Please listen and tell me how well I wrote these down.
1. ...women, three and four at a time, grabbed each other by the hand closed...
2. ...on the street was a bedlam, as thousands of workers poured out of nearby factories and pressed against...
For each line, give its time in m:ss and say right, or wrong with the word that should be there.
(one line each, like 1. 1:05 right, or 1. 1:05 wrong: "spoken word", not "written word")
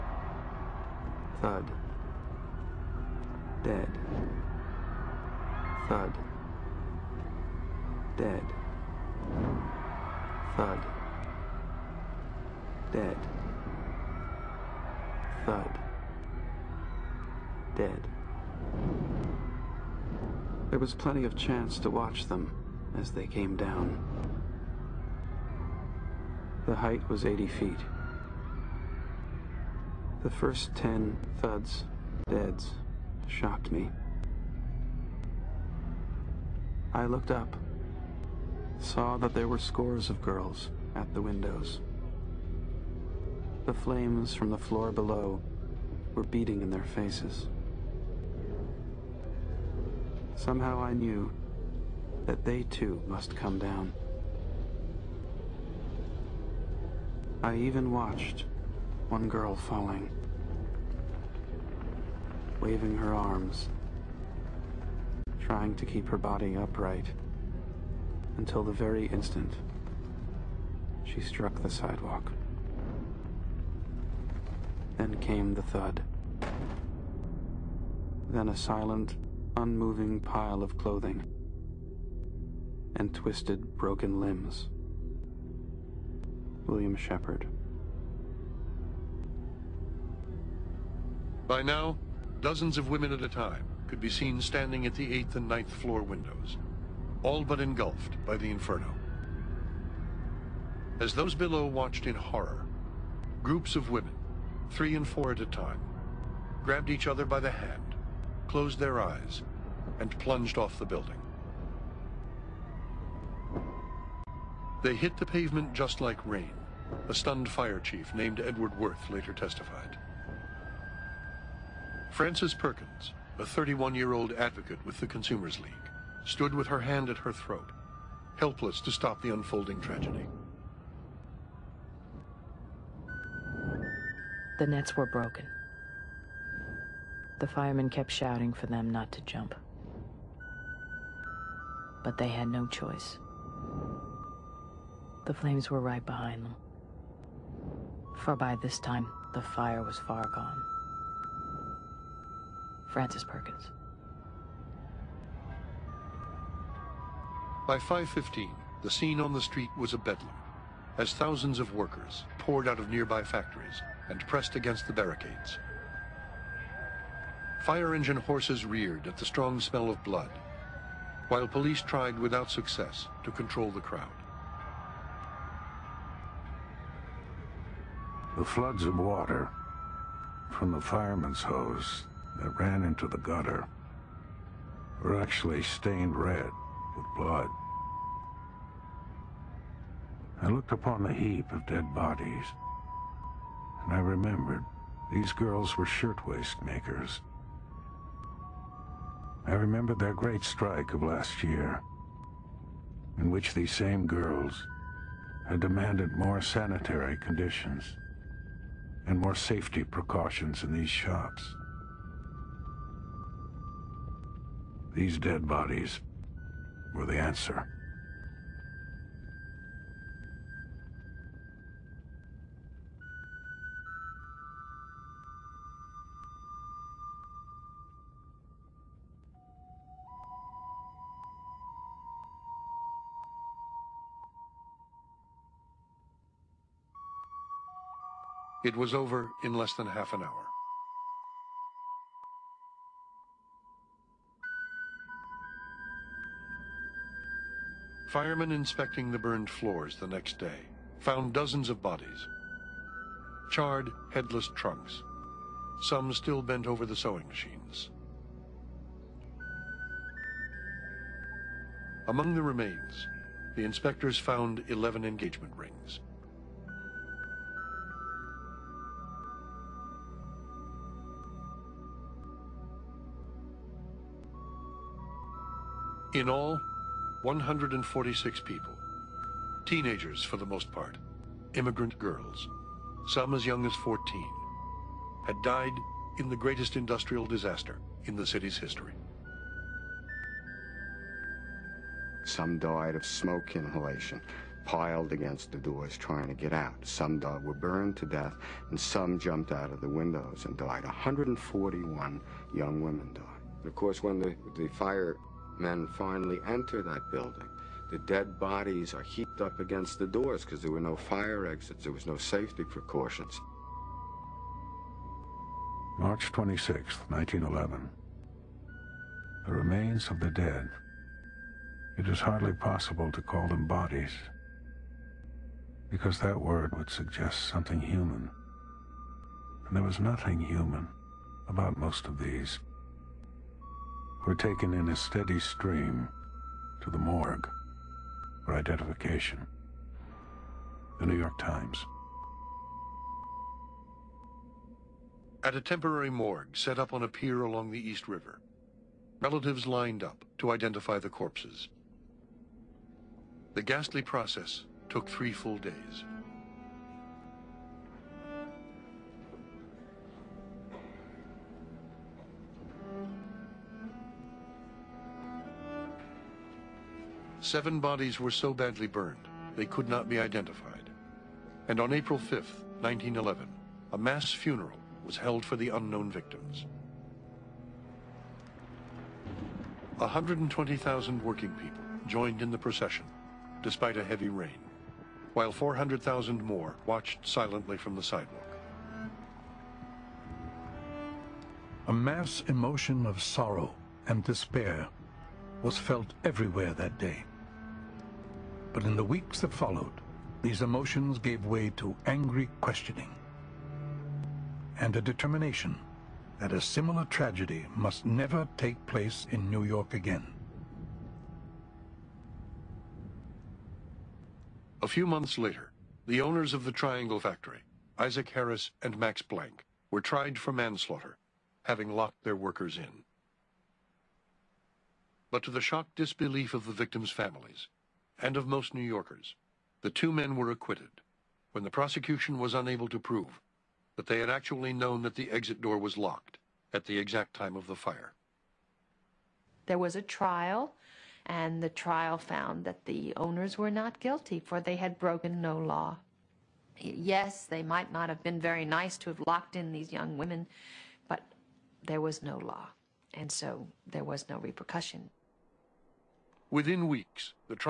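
1. 1:43 right
2. 2:39 right.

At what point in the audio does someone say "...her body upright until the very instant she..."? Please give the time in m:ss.
1:06.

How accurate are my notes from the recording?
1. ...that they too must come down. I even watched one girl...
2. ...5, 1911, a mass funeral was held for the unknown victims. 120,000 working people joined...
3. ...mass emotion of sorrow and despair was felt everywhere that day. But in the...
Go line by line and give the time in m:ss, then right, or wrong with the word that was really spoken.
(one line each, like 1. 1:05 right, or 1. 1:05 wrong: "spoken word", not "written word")
1. 0:52 right
2. 6:12 right
3. 6:31 right.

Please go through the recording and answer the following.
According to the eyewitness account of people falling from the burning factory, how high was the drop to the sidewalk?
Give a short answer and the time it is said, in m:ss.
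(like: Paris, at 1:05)
80 feet, at 0:27.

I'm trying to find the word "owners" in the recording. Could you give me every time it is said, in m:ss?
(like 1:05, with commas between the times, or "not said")
6:56, 7:23.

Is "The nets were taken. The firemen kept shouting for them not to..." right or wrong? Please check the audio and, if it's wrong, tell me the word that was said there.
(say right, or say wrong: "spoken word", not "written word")
wrong: "broken", not "taken".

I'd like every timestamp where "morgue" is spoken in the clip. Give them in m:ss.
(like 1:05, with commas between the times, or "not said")
5:36, 5:46.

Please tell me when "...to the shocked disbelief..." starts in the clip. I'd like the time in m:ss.
7:05.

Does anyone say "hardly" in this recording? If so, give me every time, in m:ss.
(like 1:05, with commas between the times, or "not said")
5:22.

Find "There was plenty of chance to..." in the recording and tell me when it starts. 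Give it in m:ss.
0:20.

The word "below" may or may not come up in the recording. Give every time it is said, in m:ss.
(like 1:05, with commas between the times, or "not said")
0:44, 1:41.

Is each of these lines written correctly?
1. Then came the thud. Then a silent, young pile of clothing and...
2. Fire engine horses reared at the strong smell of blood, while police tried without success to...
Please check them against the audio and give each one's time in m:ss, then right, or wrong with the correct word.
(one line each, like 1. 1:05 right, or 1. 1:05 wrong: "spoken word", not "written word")
1. 1:14 wrong: "unmoving", not "young"
2. 2:47 right.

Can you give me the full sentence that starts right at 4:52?
Some died of smoke inhalation, piled against the doors trying to get out.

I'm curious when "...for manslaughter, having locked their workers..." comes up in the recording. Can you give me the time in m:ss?
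7:00.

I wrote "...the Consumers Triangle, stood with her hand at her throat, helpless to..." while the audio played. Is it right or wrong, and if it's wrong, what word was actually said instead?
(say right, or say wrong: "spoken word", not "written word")
wrong: "League", not "Triangle".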